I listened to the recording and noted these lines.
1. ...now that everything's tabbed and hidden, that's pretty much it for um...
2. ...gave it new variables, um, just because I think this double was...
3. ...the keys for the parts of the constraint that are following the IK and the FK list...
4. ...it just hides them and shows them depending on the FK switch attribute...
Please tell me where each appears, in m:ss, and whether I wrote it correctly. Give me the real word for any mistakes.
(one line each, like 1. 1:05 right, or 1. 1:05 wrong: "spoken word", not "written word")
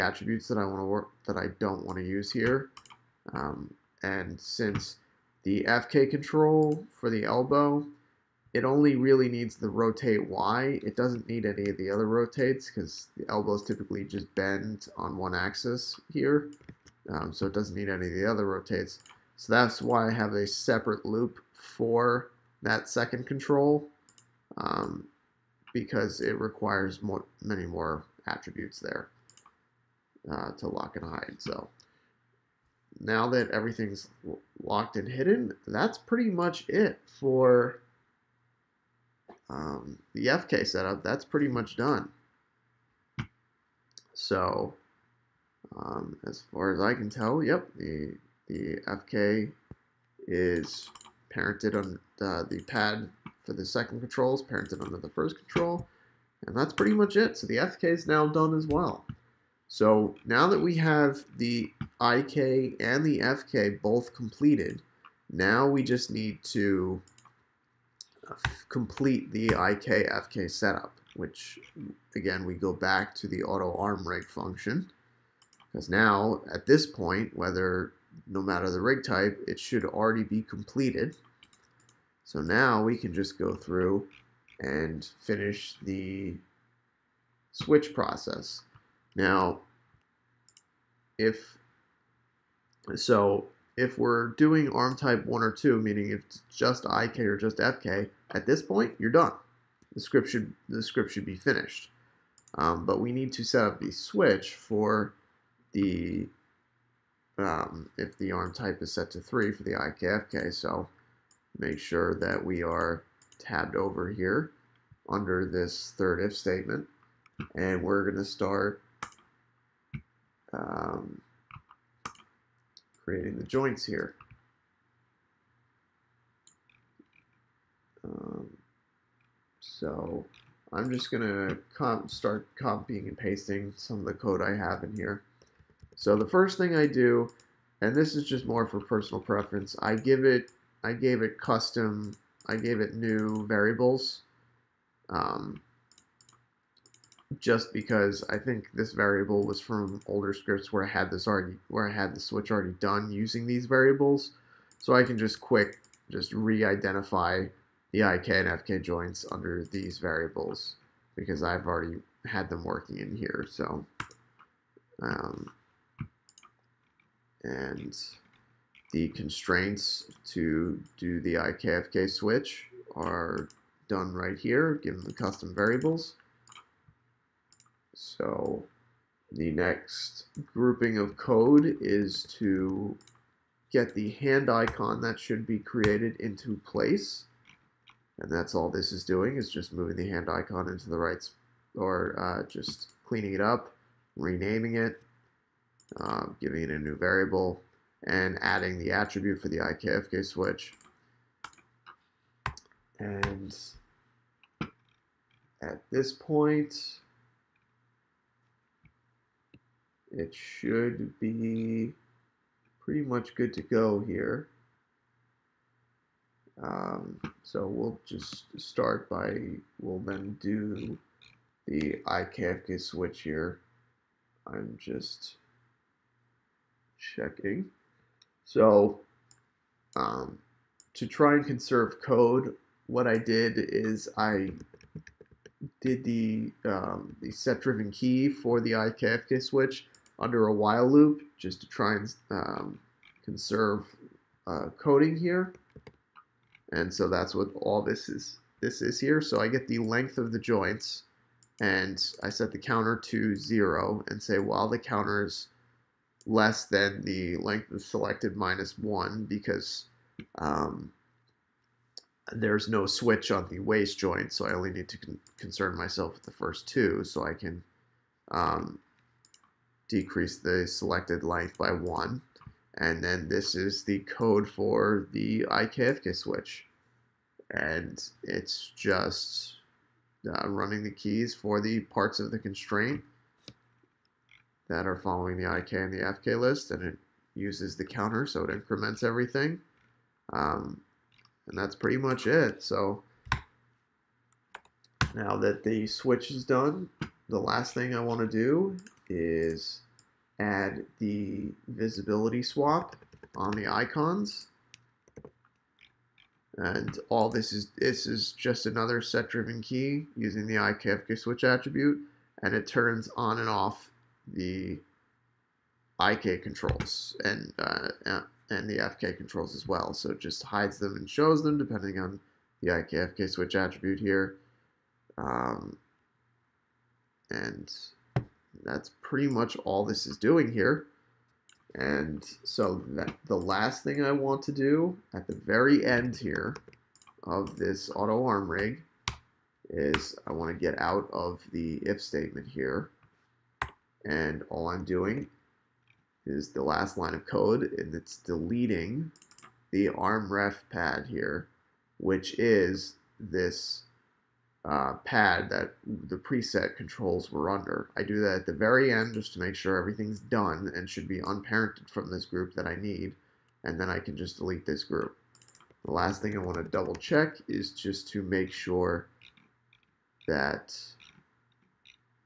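1. 0:32 wrong: "locked", not "tabbed"
2. 2:22 wrong: "variable", not "double"
3. 4:40 right
4. 5:20 right.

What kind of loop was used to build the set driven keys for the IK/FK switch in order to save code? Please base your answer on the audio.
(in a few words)
while loop.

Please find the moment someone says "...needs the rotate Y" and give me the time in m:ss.
0:09.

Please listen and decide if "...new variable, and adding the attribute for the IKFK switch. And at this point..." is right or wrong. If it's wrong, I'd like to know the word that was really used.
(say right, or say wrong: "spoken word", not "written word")
right.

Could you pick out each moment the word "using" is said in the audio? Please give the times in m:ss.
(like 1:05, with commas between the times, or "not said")
2:33, 5:10.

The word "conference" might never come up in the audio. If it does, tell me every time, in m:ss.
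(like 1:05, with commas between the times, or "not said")
not said.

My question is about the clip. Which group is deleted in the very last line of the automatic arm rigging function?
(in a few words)
arm ref pad.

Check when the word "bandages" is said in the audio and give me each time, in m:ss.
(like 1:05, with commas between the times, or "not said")
not said.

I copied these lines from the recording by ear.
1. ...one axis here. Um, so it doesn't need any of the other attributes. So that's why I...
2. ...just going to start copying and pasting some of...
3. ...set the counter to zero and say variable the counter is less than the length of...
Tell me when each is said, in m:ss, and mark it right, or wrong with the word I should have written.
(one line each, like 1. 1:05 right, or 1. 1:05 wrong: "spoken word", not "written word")
1. 0:15 wrong: "rotates", not "attributes"
2. 2:10 right
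3. 4:12 wrong: "while", not "variable".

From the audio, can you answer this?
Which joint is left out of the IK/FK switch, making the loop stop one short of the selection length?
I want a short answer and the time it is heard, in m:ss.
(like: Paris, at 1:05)
waist joint, at 4:23.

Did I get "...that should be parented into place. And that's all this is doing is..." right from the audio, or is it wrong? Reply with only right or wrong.
wrong.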